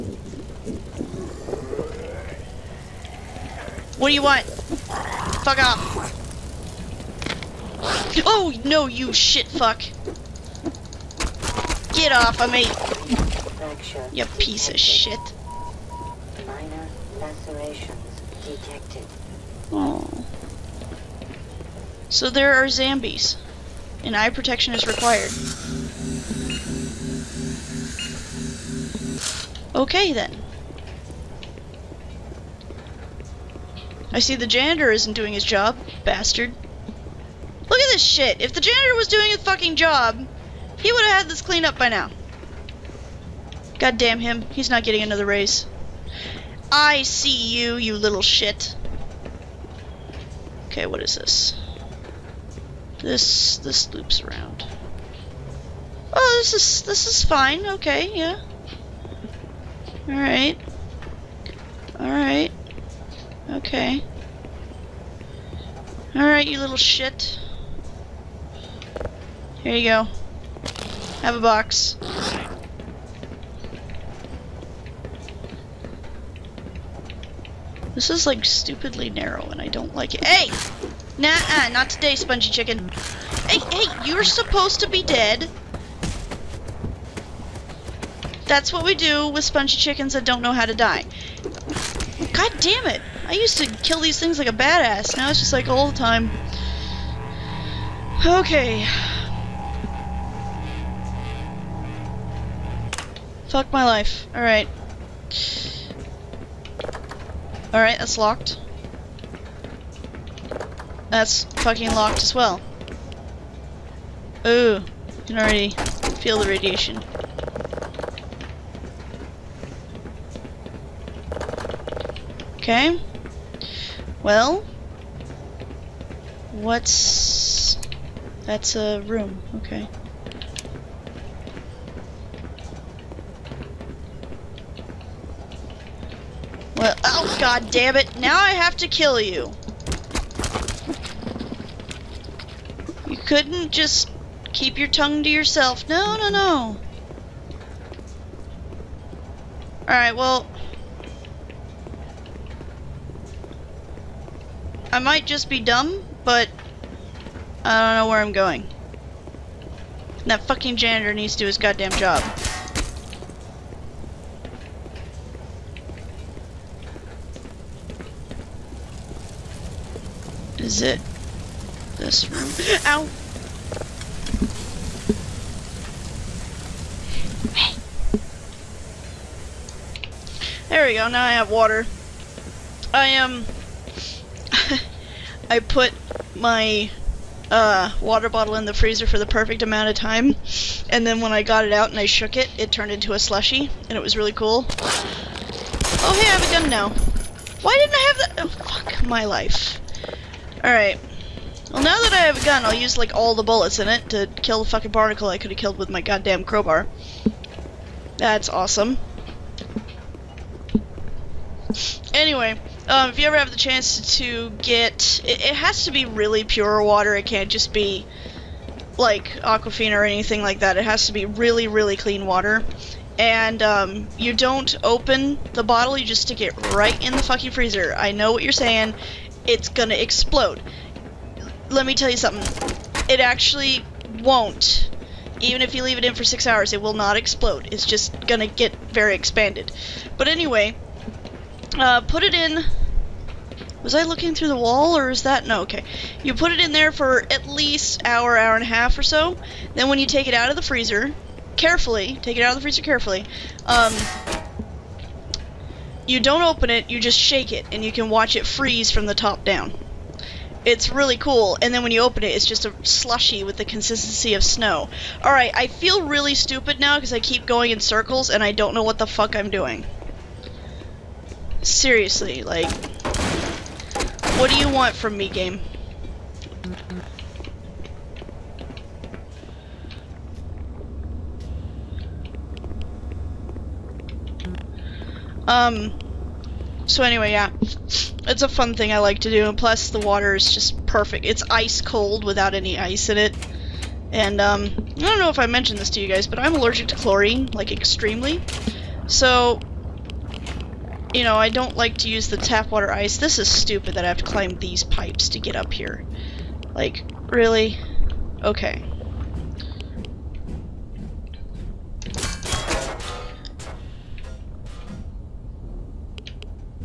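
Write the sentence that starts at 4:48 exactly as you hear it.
It's a fun thing I like to do, and plus the water is just perfect.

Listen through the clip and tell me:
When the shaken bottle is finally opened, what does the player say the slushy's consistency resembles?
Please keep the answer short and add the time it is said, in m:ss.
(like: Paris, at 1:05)
snow, at 4:24.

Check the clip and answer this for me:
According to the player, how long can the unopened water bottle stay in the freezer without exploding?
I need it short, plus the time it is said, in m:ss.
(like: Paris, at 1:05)
6 hours, at 3:56.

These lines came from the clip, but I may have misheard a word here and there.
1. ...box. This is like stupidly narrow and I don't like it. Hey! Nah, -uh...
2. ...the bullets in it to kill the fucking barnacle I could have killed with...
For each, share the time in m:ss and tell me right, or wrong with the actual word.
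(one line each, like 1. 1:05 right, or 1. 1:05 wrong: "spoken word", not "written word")
1. 1:11 right
2. 3:23 right.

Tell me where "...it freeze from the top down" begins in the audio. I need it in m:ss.
4:18.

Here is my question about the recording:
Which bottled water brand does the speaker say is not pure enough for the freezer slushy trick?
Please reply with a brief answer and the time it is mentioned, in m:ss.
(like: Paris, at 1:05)
Aquafina, at 3:39.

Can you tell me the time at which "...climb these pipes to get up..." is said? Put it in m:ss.
5:04.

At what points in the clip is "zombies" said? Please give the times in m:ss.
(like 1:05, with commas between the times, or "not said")
0:22.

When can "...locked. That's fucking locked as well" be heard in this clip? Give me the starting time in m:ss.
1:48.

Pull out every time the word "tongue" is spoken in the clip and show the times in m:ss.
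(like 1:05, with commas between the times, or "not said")
2:24.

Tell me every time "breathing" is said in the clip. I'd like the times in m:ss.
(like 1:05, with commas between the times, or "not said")
not said.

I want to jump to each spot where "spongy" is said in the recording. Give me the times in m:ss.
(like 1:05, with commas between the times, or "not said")
1:22, 1:29.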